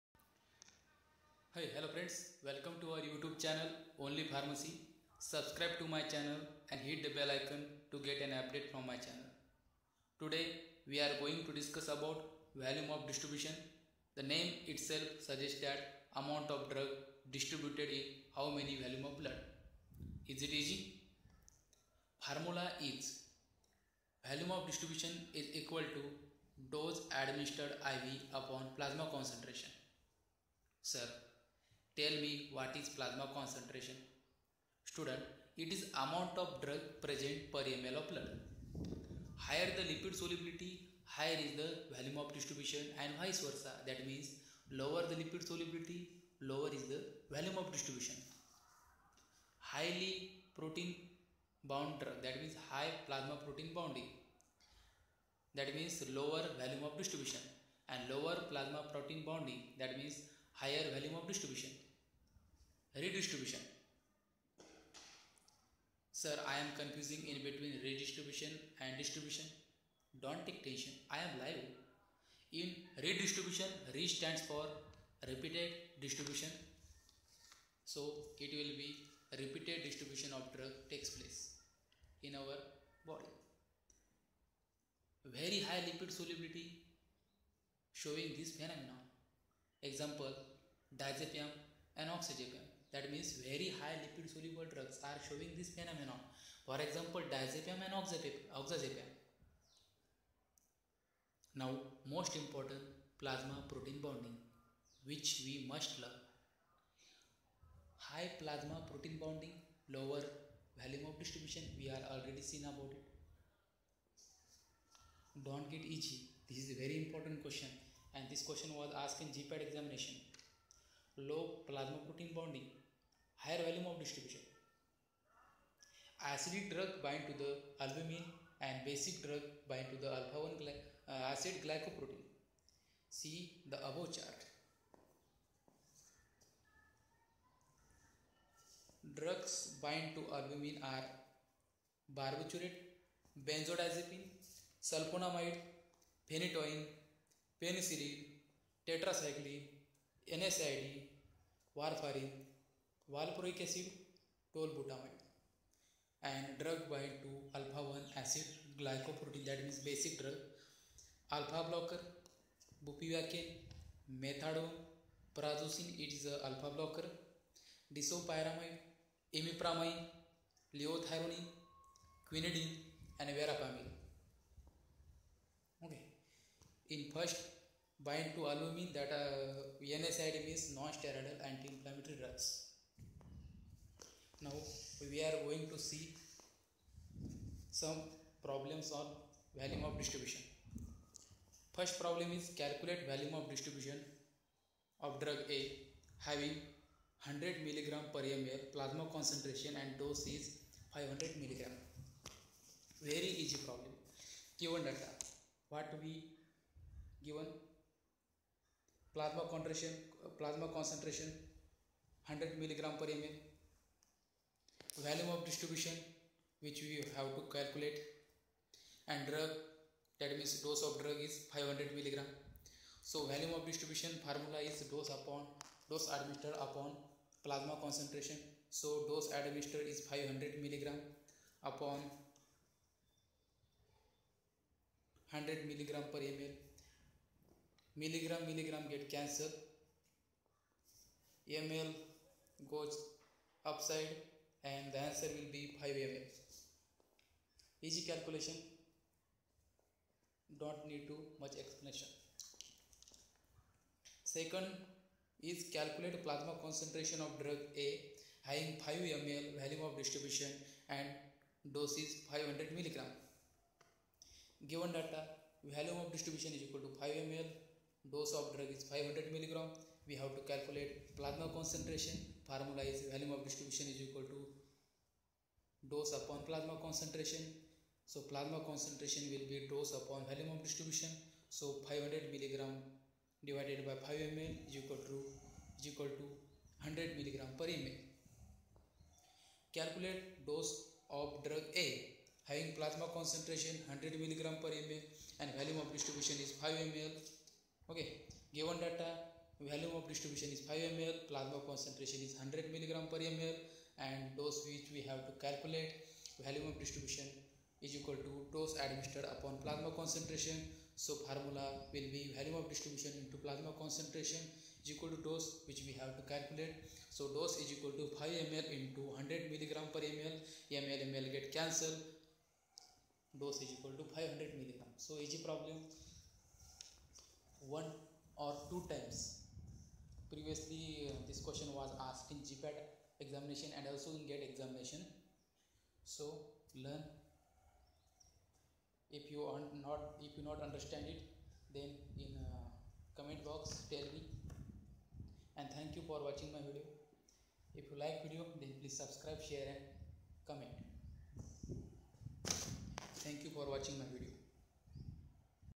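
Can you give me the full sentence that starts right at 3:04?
Now we are going to see some problems on volume of distribution.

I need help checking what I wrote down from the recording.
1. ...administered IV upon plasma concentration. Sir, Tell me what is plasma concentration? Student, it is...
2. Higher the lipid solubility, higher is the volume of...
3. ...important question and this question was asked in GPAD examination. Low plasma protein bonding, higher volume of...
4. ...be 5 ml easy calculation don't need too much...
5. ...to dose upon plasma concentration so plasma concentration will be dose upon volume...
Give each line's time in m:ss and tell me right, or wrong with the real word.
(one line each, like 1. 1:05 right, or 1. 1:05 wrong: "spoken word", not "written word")
1. 0:27 right
2. 0:39 right
3. 1:57 right
4. 4:05 right
5. 4:34 right.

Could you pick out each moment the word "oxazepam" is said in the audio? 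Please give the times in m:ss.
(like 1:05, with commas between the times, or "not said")
1:32, 1:37.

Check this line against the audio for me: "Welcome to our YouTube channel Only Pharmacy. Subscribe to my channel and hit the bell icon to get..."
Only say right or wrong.
right.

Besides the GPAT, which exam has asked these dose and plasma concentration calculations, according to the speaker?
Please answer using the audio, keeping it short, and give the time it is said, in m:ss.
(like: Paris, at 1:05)
GED, at 5:34.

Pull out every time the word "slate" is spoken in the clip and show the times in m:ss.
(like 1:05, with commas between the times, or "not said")
not said.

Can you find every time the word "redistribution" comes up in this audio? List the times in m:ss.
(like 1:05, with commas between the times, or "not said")
1:03, 1:07, 1:13.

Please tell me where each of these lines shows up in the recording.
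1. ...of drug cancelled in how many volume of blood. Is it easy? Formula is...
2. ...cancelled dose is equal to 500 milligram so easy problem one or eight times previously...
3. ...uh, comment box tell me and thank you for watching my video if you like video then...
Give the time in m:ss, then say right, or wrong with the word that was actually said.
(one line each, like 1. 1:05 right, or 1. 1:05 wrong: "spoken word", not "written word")
1. 0:16 wrong: "distributed", not "cancelled"
2. 5:21 wrong: "two", not "eight"
3. 5:42 right.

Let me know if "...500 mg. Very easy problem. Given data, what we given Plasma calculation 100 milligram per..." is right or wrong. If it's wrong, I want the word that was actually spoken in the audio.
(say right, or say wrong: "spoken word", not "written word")
wrong: "concentration", not "calculation".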